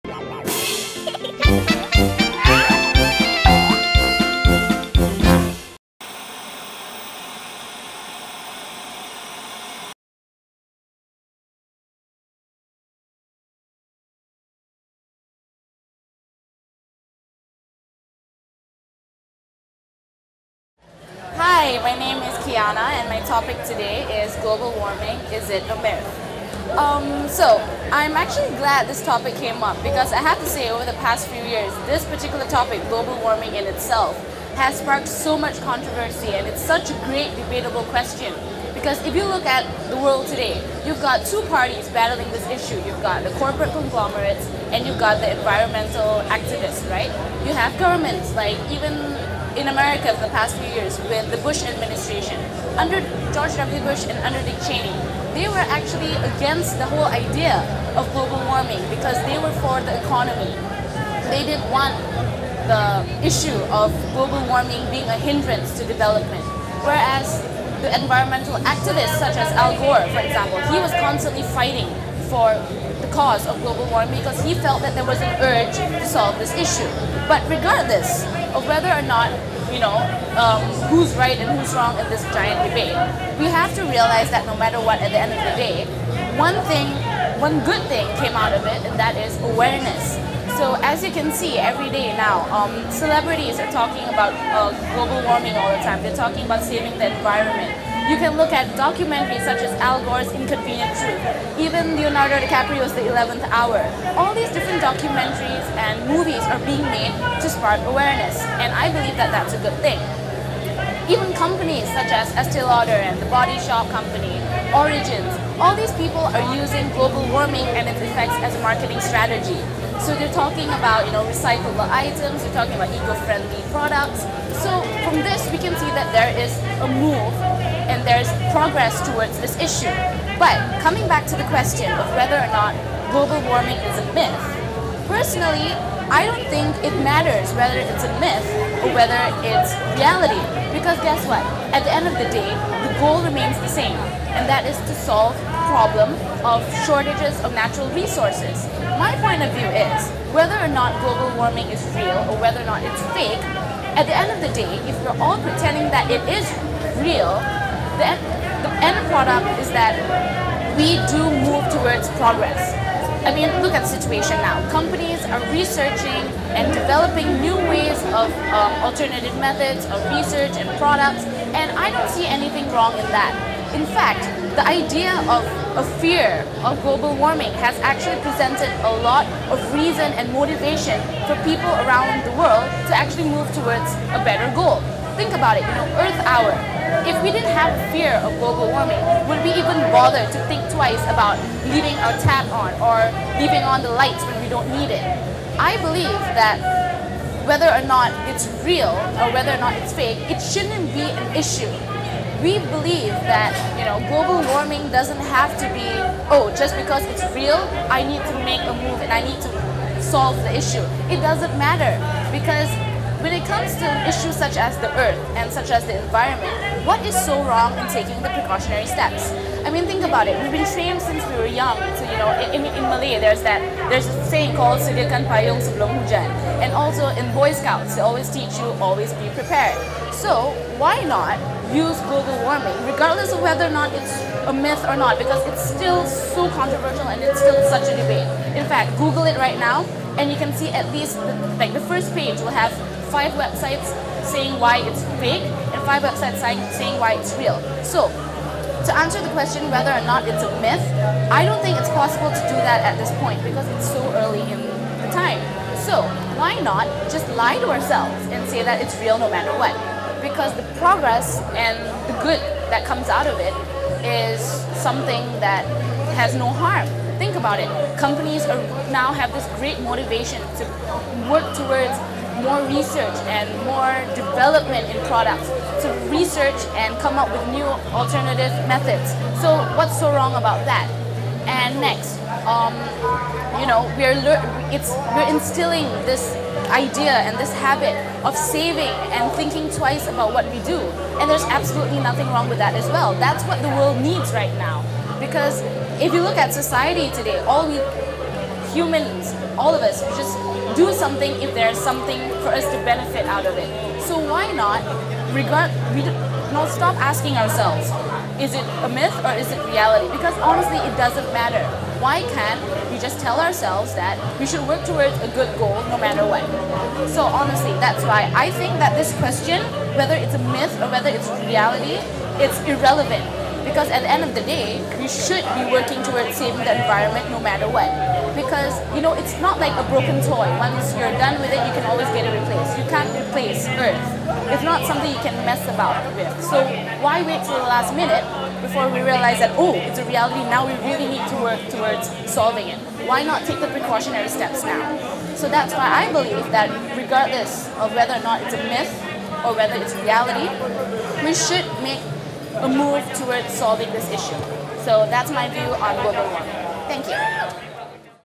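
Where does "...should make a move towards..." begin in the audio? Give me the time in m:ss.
5:51.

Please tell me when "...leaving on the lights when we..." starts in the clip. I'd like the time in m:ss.
3:13.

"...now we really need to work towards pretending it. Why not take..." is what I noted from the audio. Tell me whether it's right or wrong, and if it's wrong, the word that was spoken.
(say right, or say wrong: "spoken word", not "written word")
wrong: "solving", not "pretending".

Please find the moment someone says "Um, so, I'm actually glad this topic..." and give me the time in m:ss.
0:26.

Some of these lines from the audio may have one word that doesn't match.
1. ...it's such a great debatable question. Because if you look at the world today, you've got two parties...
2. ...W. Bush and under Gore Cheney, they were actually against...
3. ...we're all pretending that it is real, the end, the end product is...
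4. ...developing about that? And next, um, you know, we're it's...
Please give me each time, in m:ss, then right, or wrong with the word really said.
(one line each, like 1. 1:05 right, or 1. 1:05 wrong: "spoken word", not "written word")
1. 0:36 right
2. 0:53 wrong: "Dick", not "Gore"
3. 2:35 right
4. 4:40 wrong: "wrong", not "developing".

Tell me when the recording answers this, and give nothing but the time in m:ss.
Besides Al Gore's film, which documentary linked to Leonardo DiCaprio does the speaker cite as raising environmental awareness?
1:42.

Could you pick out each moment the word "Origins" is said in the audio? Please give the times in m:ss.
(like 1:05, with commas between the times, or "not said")
1:54.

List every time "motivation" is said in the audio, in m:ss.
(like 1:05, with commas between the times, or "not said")
3:00, 4:29.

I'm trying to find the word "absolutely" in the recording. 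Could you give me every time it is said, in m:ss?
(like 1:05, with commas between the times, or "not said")
4:51.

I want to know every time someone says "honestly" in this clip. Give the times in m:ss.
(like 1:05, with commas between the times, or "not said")
5:10, 5:17.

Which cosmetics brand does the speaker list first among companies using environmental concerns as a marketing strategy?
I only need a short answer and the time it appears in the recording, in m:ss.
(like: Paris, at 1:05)
Estee Lauder, at 1:52.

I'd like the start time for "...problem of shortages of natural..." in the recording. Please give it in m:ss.
2:25.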